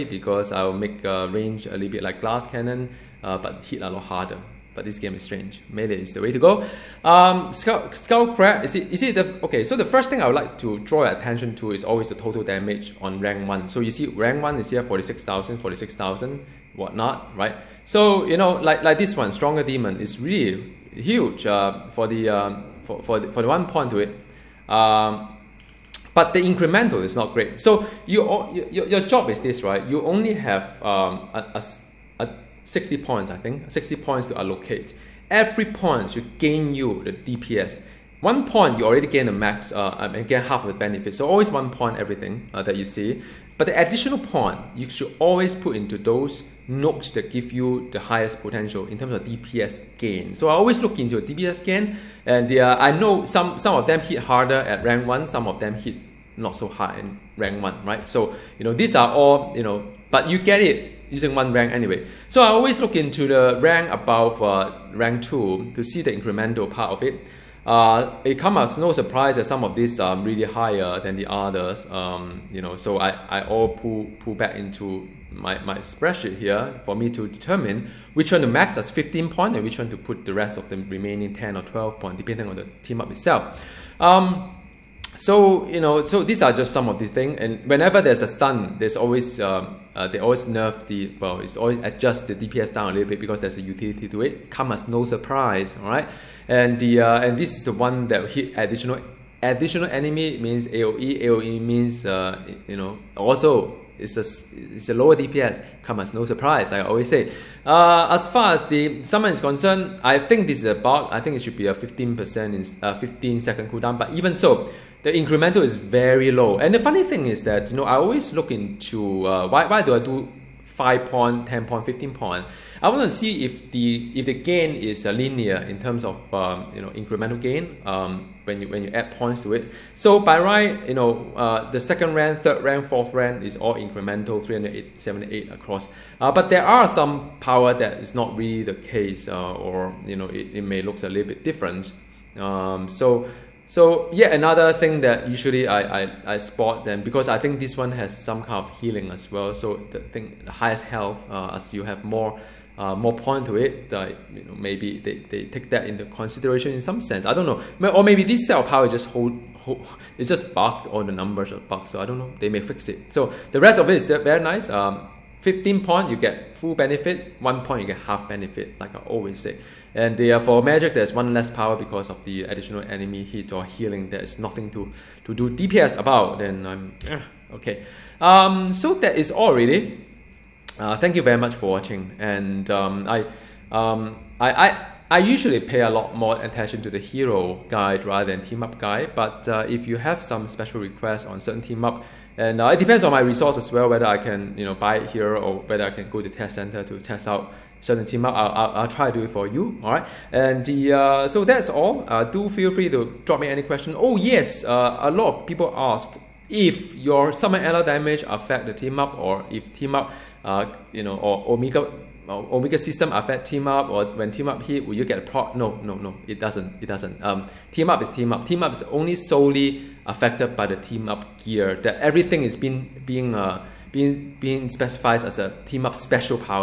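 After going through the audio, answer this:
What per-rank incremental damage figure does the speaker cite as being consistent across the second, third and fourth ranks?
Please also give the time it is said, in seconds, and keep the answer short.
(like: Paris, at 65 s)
378, at 134 s.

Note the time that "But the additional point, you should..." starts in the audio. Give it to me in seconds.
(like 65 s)
43 s.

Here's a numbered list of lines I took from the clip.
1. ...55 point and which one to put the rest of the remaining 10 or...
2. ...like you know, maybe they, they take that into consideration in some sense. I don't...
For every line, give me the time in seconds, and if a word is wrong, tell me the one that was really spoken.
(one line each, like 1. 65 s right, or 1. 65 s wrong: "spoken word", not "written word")
1. 78 s wrong: "15", not "55"
2. 153 s right.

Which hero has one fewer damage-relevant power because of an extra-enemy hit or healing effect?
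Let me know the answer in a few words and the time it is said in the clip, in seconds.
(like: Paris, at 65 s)
Magik, at 170 s.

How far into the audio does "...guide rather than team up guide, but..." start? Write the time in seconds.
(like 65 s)
187 s.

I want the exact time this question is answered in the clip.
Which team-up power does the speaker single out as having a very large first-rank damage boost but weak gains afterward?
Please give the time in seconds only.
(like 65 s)
19 s.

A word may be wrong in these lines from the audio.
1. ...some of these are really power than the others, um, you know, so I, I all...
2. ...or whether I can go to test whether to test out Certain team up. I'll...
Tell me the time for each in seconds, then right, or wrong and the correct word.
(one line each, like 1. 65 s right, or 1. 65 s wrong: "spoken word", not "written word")
1. 69 s wrong: "higher", not "power"
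2. 195 s wrong: "center", not "whether".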